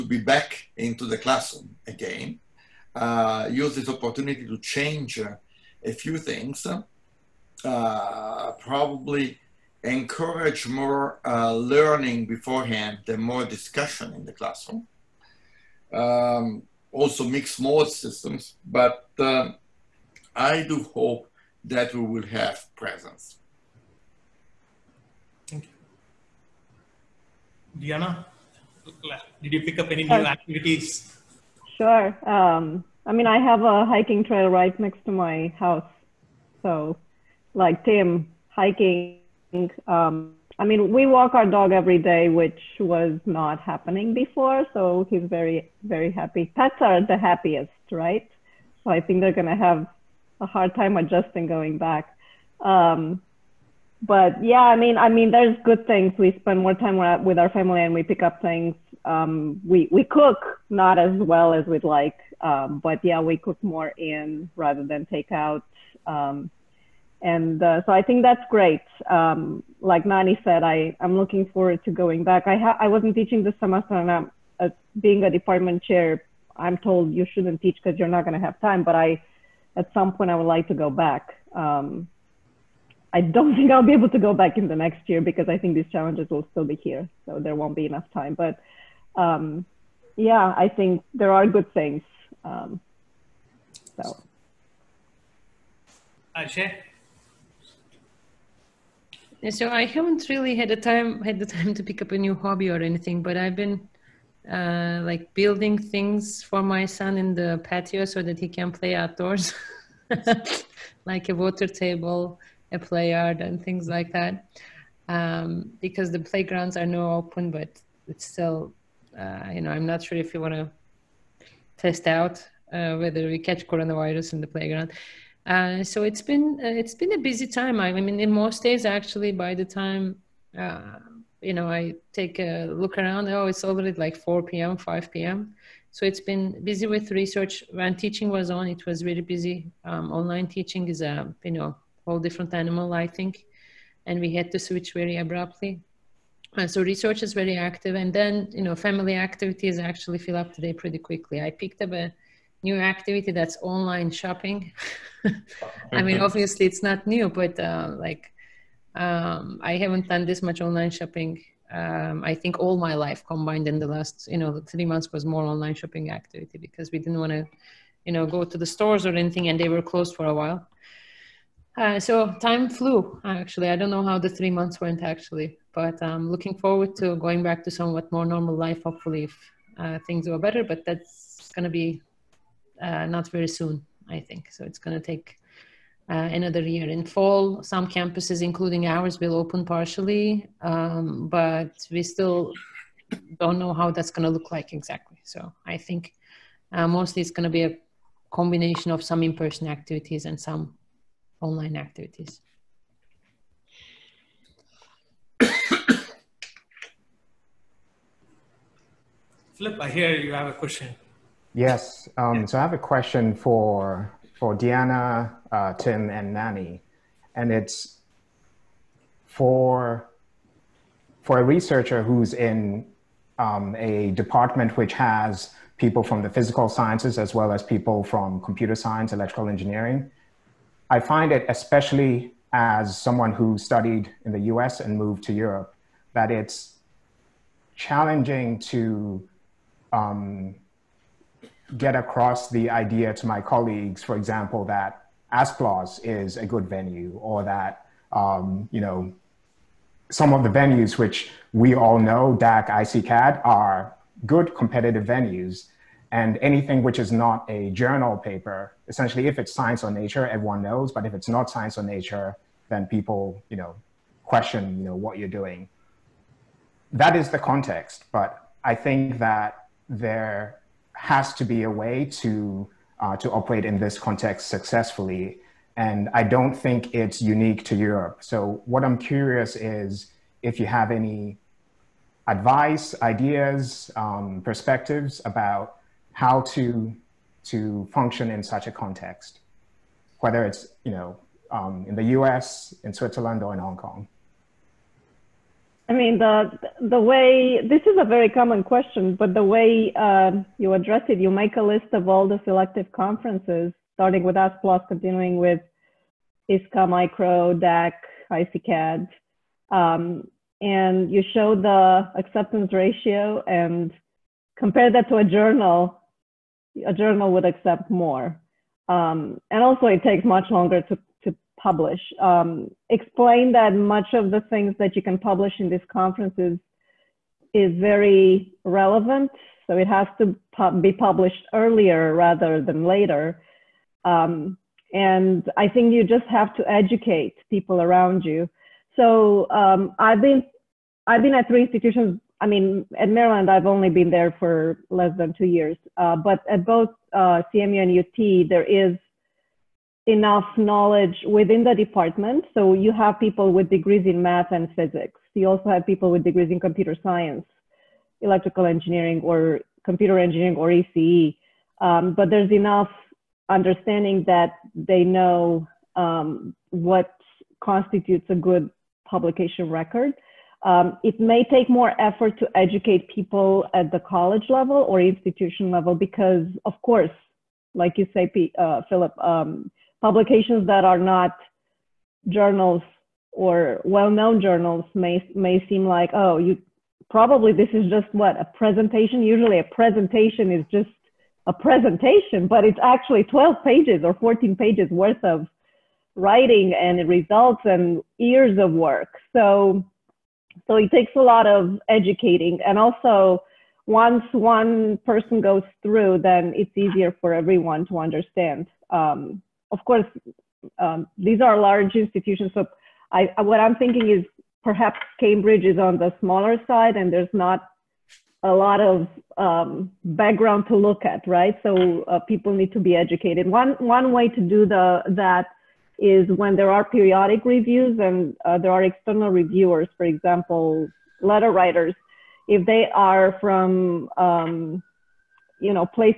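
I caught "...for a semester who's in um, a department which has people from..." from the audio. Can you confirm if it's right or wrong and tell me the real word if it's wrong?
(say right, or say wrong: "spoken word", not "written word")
wrong: "researcher", not "semester".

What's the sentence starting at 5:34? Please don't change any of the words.
Um, and I think you just have to educate people around you.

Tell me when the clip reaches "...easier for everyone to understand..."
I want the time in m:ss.
6:46.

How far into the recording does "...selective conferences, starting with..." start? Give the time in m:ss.
5:02.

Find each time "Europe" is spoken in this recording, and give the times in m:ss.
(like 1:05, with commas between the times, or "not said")
3:55, 4:37.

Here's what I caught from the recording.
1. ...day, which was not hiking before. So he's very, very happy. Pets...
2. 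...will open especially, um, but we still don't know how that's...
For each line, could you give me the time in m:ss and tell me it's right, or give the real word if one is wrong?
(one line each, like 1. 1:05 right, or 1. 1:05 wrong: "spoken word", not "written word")
1. 0:41 wrong: "happening", not "hiking"
2. 3:09 wrong: "partially", not "especially".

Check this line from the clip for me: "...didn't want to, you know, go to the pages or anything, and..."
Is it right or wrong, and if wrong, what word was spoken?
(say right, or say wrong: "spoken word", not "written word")
wrong: "stores", not "pages".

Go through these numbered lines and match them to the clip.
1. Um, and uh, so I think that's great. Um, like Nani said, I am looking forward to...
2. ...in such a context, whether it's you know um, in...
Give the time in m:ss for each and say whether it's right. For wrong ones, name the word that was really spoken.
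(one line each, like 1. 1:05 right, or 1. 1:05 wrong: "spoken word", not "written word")
1. 1:06 right
2. 4:48 right.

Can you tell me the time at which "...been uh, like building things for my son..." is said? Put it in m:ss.
1:43.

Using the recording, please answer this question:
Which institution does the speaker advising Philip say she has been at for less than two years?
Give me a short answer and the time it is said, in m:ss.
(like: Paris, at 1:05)
Maryland, at 5:43.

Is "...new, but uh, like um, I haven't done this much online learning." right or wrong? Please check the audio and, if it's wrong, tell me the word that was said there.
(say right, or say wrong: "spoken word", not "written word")
wrong: "shopping", not "learning".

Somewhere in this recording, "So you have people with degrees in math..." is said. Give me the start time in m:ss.
5:52.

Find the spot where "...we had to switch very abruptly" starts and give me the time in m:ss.
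2:24.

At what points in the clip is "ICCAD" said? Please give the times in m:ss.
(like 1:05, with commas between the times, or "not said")
4:12, 5:08.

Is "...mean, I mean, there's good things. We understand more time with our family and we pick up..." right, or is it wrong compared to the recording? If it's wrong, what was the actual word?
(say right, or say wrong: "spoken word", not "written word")
wrong: "spend", not "understand".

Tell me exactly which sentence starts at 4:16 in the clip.
And anything which is not a journal paper, essentially, if it's science or nature, everyone knows.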